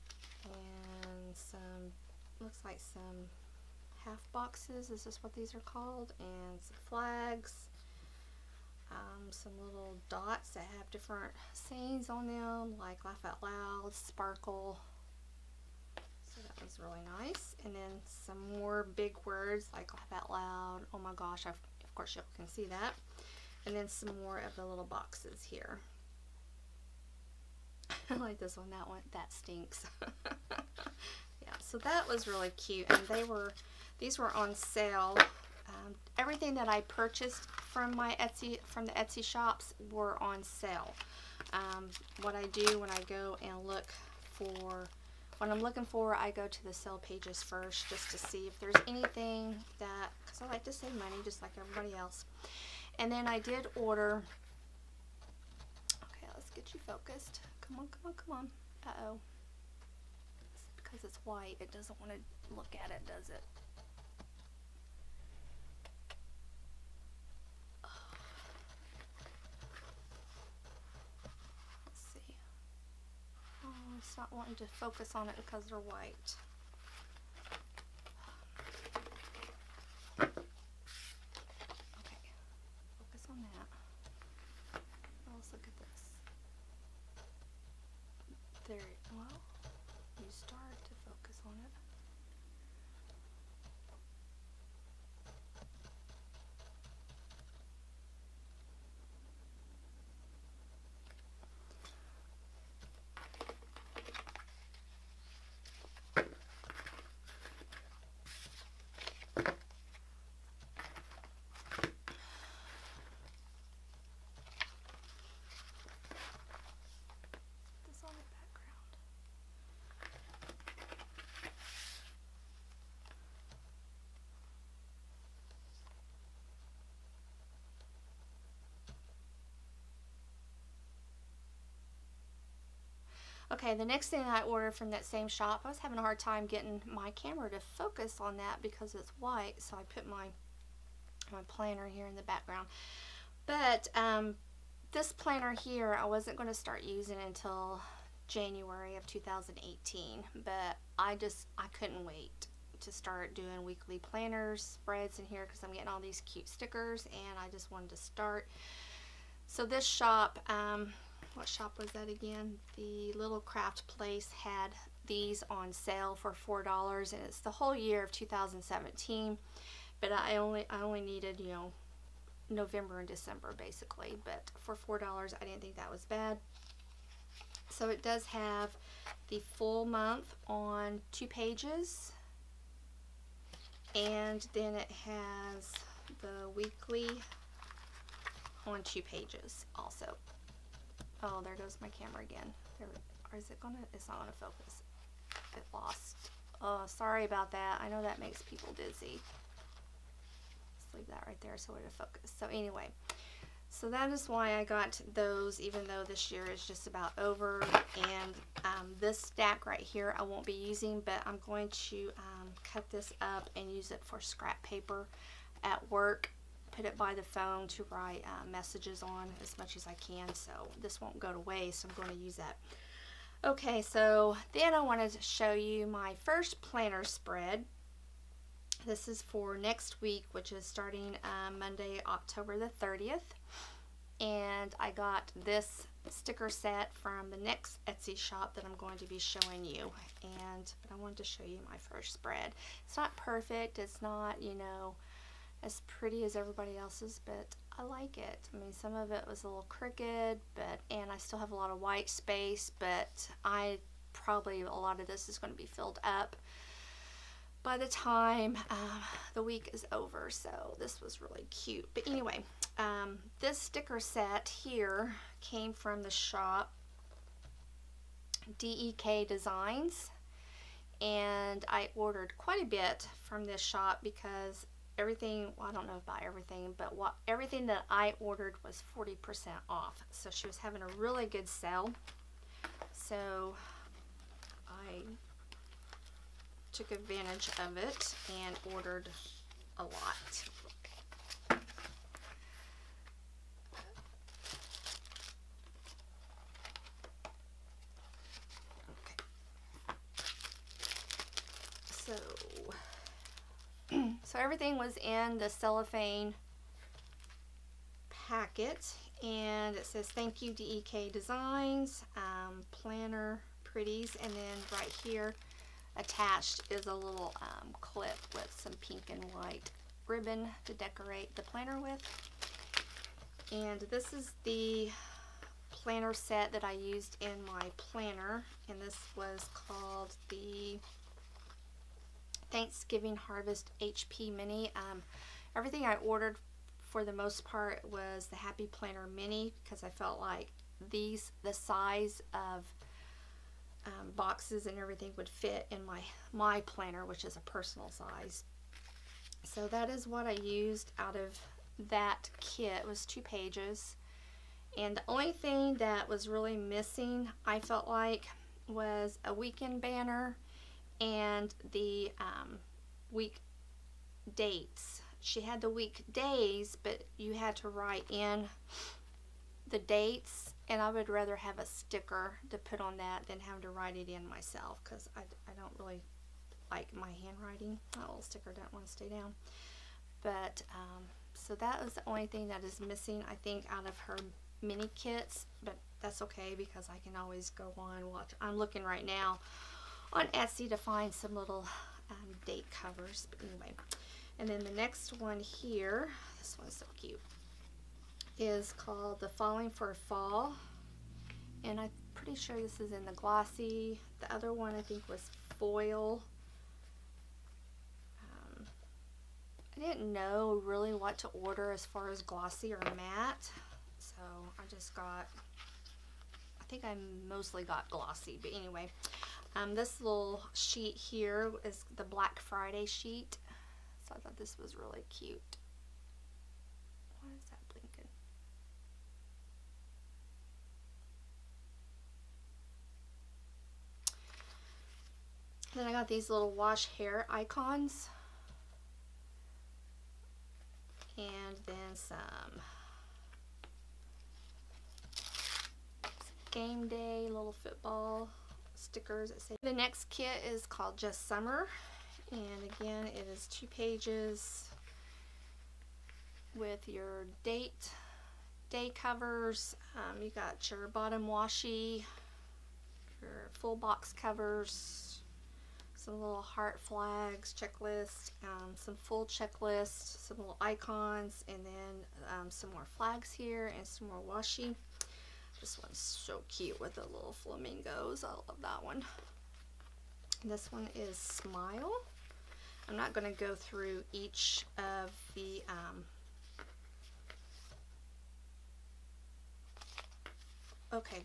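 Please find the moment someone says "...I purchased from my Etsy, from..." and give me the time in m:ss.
0:36.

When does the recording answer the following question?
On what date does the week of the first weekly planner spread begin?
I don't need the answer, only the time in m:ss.
3:52.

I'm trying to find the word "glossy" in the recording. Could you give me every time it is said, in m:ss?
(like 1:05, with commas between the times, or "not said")
6:43, 6:52, 6:57.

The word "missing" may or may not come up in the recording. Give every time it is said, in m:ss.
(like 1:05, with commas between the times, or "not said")
5:56, 6:22.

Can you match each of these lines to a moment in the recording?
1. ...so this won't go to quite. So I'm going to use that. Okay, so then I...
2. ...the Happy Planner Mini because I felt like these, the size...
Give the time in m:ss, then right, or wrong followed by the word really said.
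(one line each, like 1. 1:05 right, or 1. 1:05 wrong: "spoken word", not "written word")
1. 3:40 wrong: "waste", not "quite"
2. 5:38 right.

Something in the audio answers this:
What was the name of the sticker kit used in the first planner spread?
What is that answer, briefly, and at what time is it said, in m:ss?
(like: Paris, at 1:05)
Thanksgiving Harvest HP Mini, at 5:32.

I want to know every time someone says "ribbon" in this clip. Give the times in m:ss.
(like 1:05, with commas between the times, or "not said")
5:20.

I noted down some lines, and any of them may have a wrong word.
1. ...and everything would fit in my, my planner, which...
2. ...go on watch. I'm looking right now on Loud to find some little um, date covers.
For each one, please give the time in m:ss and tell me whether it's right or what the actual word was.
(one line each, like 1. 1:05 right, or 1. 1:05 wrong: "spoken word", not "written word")
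1. 5:44 right
2. 6:27 wrong: "Etsy", not "Loud".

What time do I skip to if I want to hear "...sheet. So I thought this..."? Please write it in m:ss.
7:02.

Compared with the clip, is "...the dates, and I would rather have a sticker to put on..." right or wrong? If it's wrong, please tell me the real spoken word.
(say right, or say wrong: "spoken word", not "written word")
right.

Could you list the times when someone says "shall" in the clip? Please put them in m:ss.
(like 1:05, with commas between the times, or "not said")
not said.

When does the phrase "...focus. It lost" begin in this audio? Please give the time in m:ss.
3:14.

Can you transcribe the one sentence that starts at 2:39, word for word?
So this shop, um, what shop was that again?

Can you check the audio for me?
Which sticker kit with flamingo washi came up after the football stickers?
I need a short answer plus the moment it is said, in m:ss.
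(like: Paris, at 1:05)
Just Summer, at 7:30.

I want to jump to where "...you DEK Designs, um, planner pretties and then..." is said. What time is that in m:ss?
5:10.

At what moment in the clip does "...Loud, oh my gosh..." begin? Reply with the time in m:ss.
0:20.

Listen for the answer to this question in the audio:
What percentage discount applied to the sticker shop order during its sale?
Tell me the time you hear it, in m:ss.
4:38.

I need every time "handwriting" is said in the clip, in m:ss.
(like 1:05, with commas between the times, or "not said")
6:17.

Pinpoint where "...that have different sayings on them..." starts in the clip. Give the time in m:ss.
0:10.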